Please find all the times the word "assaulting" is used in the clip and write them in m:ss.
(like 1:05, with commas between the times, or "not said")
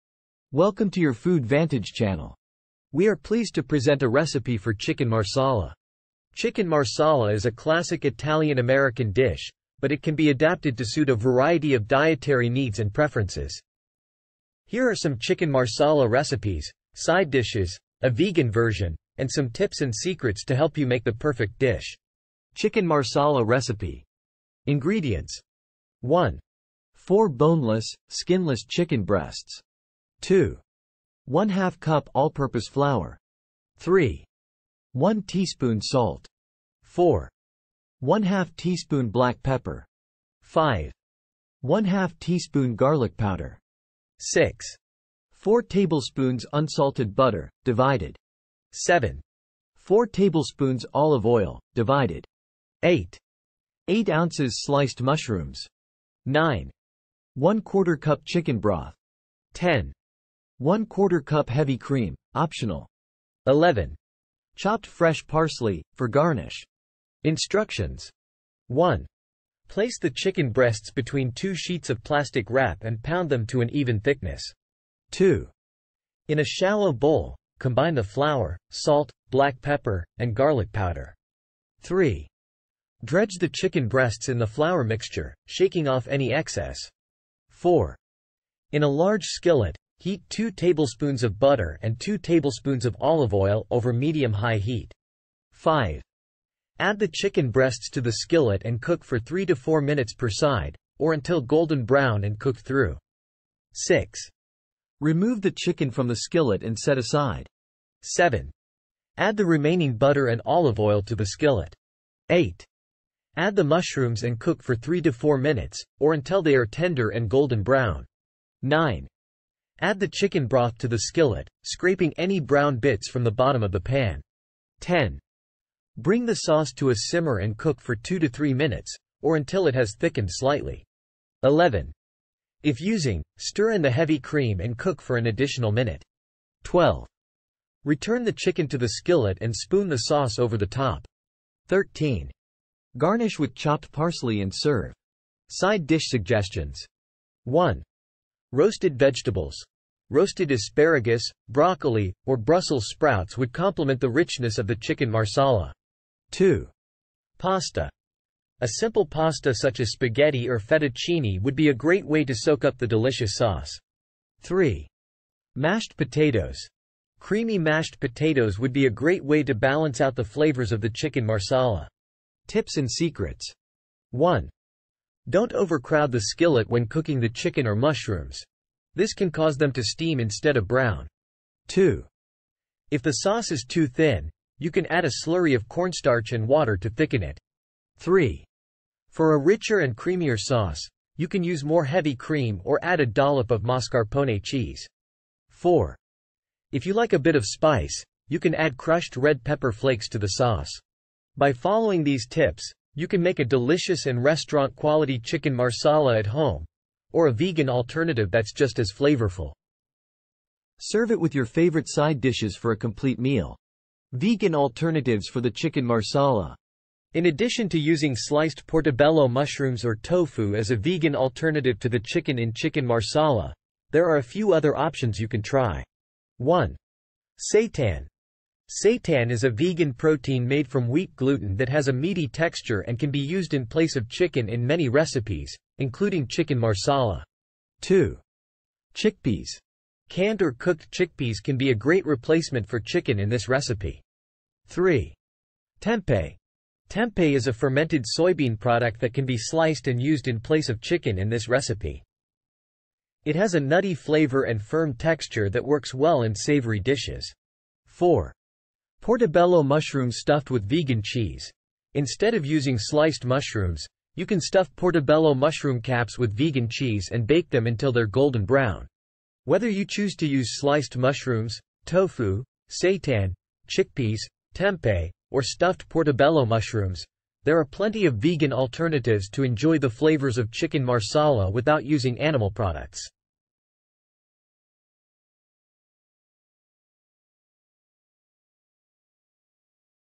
not said.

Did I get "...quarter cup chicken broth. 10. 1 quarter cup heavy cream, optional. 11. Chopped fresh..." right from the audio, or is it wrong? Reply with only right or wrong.
right.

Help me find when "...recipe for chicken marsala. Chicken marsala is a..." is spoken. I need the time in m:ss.
0:04.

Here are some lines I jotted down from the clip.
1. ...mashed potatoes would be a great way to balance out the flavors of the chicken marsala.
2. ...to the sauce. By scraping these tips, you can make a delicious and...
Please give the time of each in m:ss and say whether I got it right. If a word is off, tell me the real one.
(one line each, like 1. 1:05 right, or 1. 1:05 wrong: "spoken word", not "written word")
1. 2:47 right
2. 3:20 wrong: "following", not "scraping".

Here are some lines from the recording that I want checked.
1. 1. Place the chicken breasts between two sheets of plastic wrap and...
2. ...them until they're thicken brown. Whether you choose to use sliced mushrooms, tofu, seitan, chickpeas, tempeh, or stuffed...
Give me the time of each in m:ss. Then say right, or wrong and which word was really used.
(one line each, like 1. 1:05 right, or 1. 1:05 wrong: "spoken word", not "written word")
1. 1:08 right
2. 4:27 wrong: "golden", not "thicken".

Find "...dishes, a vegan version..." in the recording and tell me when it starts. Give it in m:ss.
0:17.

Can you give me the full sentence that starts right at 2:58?
This can cause them to steam instead of brown.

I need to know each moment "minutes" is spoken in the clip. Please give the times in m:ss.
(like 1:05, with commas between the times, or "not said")
1:39, 1:55, 2:08, 2:15.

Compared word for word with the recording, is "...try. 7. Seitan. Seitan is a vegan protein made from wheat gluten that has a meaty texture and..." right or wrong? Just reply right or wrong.
wrong.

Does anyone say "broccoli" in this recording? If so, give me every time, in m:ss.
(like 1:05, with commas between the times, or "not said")
2:31.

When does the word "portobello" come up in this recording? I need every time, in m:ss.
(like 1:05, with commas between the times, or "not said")
3:38, 4:19, 4:24, 4:35.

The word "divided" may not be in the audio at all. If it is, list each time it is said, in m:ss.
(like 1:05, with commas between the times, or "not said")
0:47, 0:51.